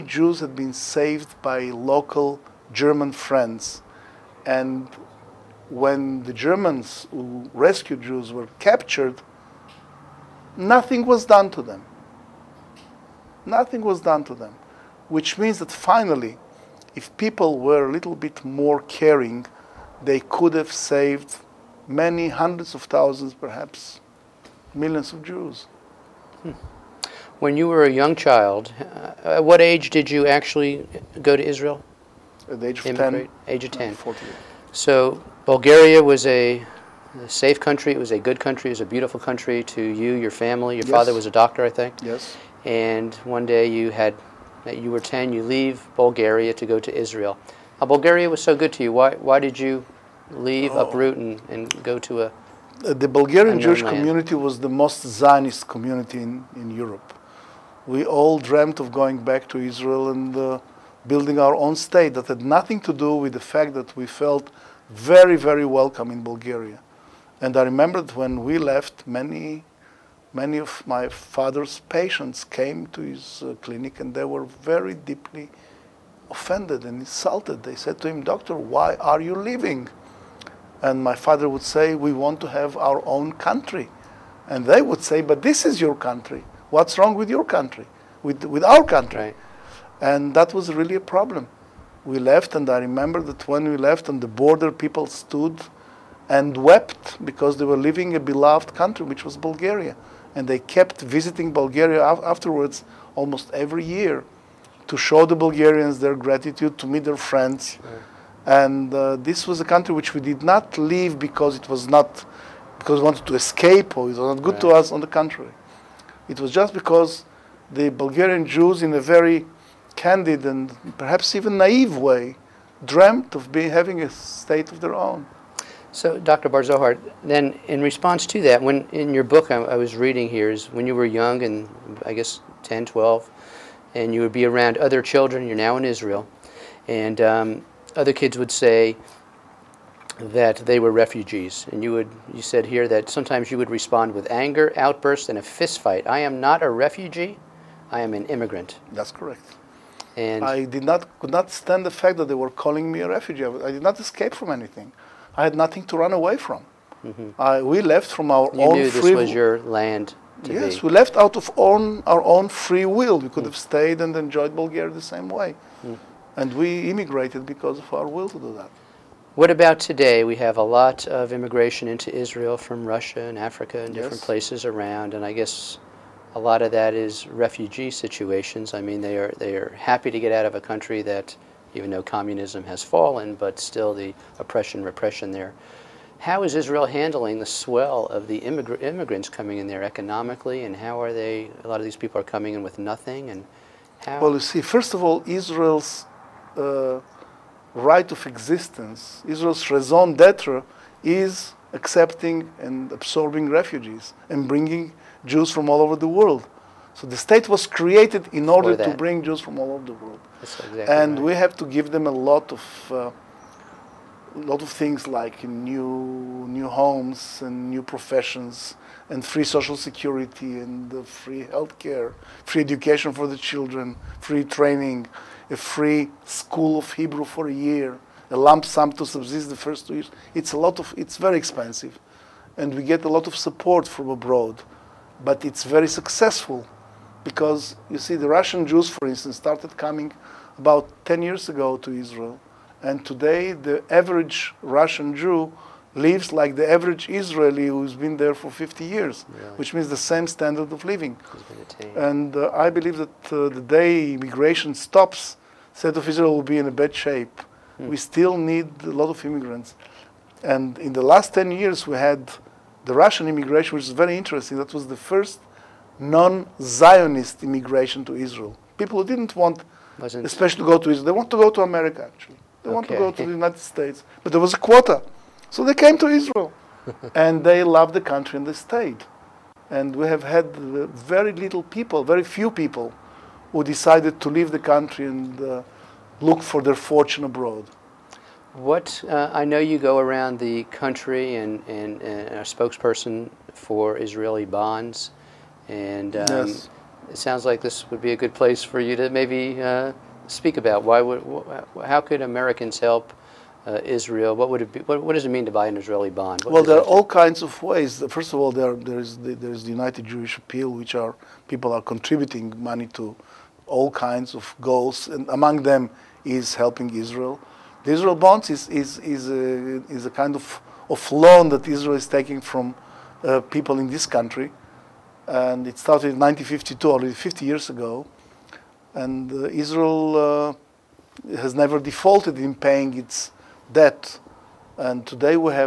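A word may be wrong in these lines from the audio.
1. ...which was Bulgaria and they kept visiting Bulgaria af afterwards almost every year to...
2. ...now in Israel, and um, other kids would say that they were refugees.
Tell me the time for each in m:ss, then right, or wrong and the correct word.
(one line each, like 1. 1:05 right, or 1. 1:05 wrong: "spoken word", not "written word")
1. 1:39 right
2. 2:15 right.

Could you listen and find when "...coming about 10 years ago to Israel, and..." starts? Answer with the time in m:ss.
3:59.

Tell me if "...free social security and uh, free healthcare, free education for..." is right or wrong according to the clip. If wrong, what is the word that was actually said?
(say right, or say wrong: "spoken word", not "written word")
right.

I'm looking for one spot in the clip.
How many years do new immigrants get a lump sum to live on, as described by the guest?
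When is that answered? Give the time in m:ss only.
3:49.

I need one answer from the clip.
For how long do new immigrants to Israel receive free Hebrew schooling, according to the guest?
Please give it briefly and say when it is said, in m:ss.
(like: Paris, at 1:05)
A year, at 3:47.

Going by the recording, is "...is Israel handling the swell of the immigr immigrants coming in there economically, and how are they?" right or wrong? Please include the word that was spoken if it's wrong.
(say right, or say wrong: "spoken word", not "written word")
right.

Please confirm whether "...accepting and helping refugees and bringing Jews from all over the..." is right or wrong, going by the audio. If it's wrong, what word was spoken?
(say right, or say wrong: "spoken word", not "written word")
wrong: "absorbing", not "helping".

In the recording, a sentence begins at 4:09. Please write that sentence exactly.
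which means the same standard of living.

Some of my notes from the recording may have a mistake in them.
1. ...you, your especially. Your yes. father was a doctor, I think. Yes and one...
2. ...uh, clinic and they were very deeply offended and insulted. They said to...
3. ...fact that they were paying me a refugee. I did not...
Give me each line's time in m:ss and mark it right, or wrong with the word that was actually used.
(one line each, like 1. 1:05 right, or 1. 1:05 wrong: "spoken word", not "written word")
1. 0:39 wrong: "family", not "especially"
2. 1:13 right
3. 2:31 wrong: "calling", not "paying".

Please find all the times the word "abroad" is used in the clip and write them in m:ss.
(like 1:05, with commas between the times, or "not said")
3:54, 4:47.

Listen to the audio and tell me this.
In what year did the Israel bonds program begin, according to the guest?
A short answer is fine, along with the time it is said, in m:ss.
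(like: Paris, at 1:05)
1952, at 5:26.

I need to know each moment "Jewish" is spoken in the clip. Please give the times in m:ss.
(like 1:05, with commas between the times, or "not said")
0:53, 5:10.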